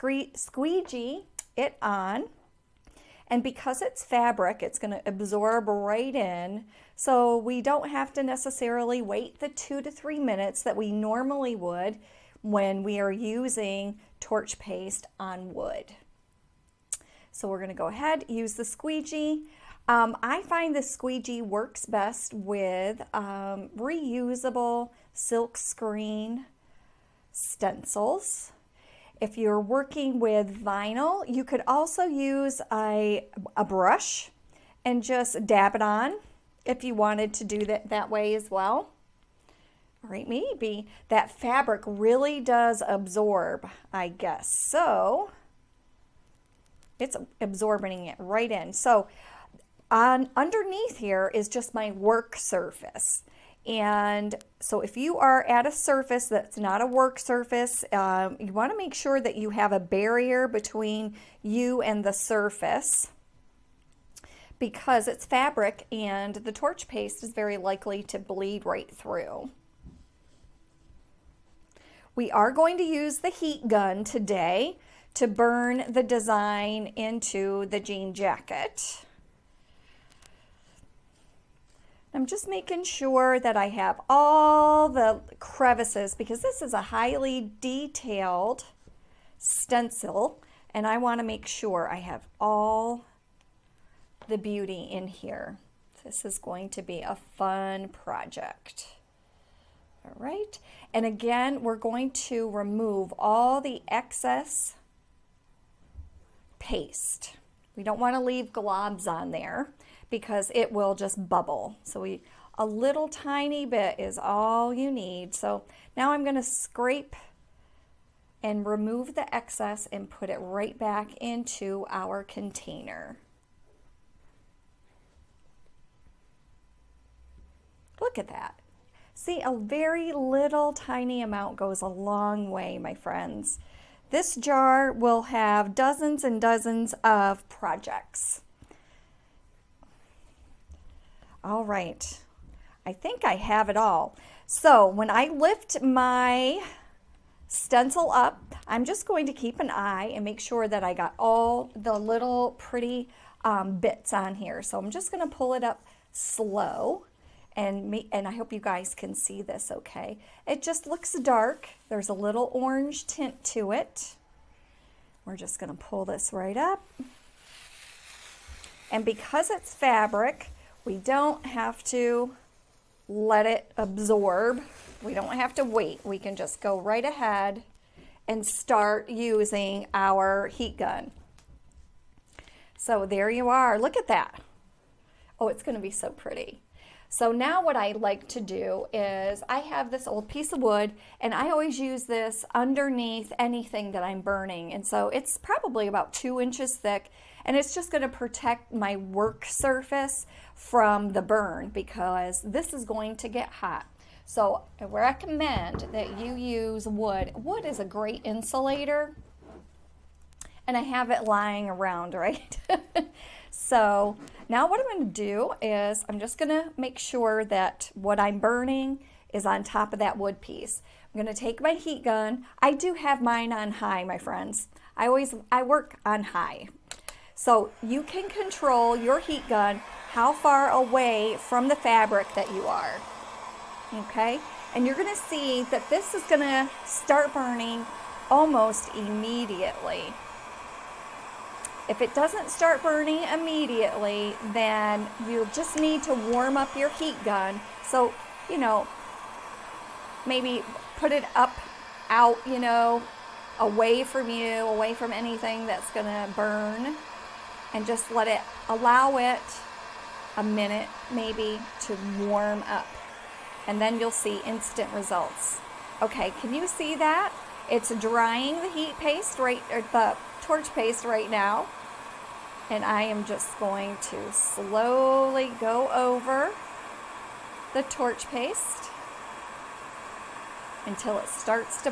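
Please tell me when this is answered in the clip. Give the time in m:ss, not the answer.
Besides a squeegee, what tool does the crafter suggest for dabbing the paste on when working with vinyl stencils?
0:33.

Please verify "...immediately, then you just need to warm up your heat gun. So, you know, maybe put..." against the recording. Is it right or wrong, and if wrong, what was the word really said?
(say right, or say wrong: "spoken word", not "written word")
right.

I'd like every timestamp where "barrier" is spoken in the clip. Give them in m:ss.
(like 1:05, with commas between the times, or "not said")
0:59.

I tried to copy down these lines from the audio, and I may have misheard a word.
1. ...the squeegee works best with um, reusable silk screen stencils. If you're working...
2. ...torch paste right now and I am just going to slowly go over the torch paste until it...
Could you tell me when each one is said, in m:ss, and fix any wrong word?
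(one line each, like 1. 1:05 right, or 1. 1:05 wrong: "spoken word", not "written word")
1. 0:20 right
2. 4:30 right.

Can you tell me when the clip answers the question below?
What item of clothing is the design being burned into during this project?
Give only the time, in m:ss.
1:17.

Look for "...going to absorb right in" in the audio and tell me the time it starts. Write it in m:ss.
0:04.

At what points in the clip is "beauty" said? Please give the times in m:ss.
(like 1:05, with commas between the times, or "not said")
1:34.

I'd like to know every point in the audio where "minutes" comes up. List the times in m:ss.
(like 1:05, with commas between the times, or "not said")
0:10, 4:20.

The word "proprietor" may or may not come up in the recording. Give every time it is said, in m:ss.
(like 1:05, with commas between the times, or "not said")
not said.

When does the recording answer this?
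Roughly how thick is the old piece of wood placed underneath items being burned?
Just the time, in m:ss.
3:16.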